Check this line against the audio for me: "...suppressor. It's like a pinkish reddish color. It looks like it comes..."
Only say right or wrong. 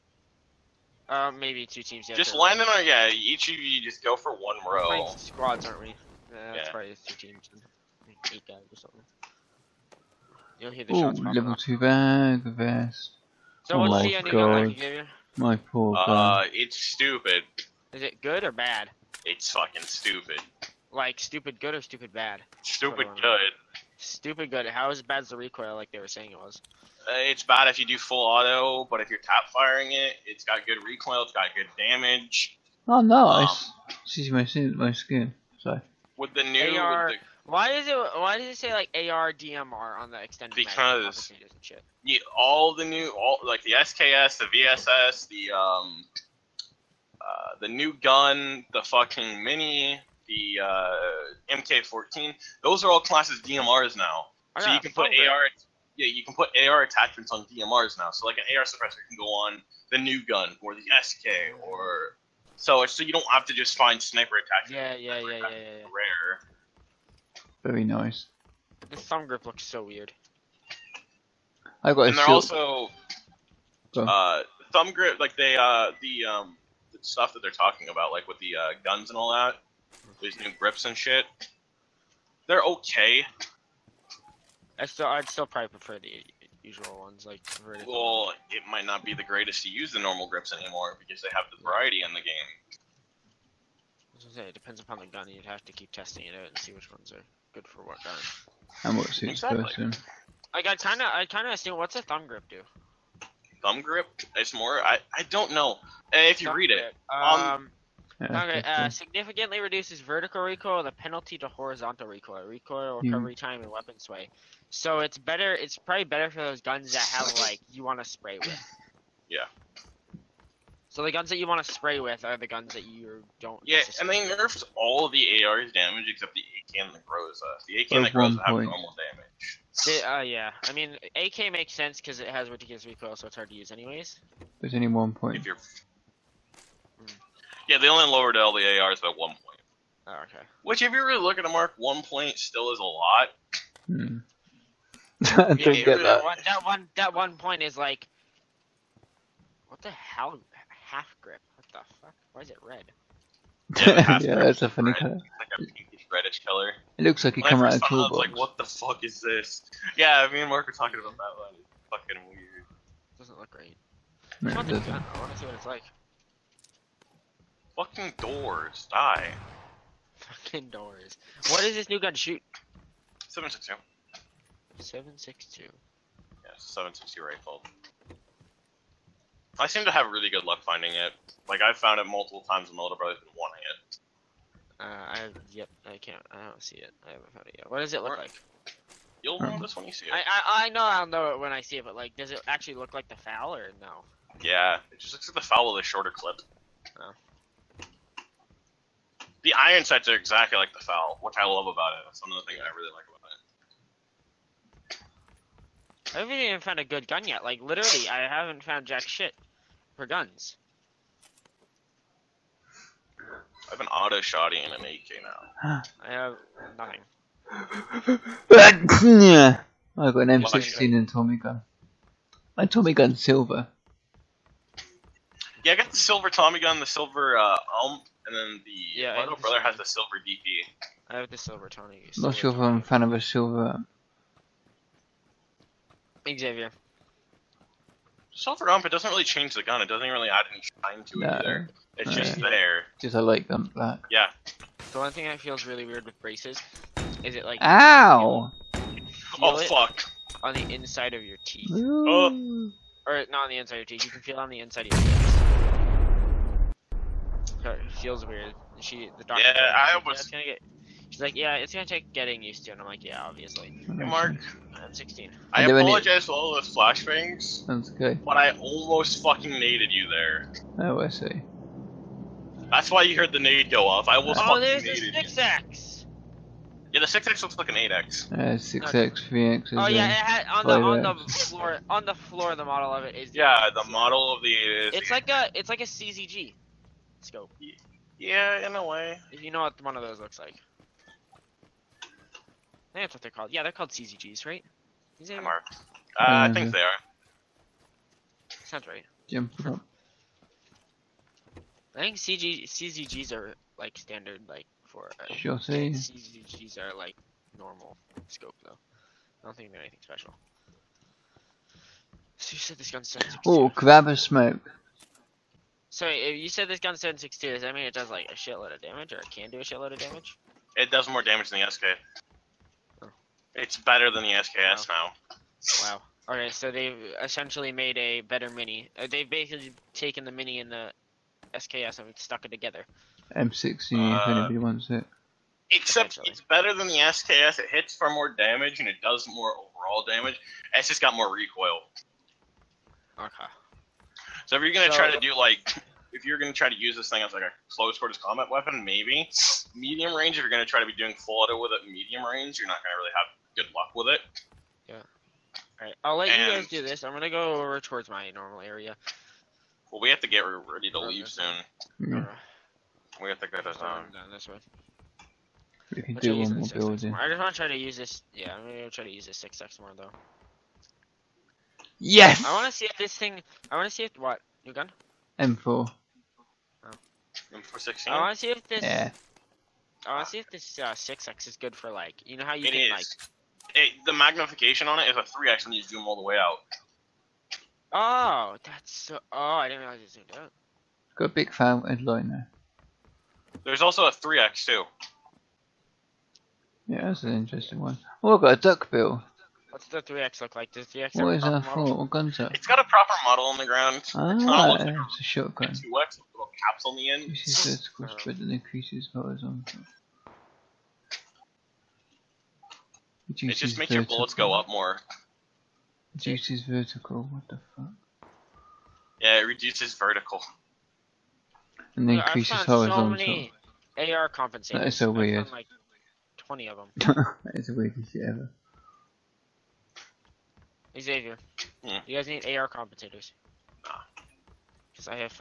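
wrong.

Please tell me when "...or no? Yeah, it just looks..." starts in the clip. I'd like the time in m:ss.
3:13.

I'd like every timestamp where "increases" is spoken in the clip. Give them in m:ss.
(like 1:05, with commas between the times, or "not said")
6:48, 7:02.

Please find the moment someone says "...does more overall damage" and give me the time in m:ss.
5:39.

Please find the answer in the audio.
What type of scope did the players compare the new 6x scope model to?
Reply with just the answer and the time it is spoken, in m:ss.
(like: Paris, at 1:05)
CZG scope, at 4:45.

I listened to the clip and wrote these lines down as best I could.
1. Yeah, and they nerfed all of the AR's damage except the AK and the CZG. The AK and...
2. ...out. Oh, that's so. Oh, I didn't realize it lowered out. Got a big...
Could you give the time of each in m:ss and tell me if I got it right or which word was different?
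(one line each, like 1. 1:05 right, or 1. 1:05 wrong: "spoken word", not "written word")
1. 2:03 wrong: "Groza", not "CZG"
2. 6:26 wrong: "zoomed", not "lowered".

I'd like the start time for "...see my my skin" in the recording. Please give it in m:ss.
0:34.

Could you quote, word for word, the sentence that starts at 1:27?
Well, it might not be the greatest to use the normal grips anymore because they have the variety in the game.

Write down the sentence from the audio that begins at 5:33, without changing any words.
M16, uh, if anybody wants it.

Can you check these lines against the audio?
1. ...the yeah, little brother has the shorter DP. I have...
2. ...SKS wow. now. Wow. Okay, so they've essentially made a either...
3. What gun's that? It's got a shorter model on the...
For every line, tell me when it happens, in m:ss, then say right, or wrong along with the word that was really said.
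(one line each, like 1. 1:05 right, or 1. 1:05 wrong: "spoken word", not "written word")
1. 3:48 wrong: "silver", not "shorter"
2. 5:24 wrong: "better", not "either"
3. 6:41 wrong: "proper", not "shorter".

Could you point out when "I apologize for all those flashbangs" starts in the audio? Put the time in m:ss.
4:25.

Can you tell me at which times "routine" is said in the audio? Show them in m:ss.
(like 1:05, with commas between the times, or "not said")
not said.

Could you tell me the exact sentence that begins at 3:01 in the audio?
Like, I've found it multiple times and my little brother's been wanting it.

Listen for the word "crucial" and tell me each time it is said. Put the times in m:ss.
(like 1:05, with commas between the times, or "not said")
not said.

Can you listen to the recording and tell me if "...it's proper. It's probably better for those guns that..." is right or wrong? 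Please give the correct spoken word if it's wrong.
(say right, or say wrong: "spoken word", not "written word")
wrong: "better", not "proper".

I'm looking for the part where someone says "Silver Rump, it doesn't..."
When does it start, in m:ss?
3:58.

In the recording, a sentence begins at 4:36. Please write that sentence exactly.
Yeah, the six X looks like an eight X.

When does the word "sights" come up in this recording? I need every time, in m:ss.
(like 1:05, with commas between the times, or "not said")
3:19.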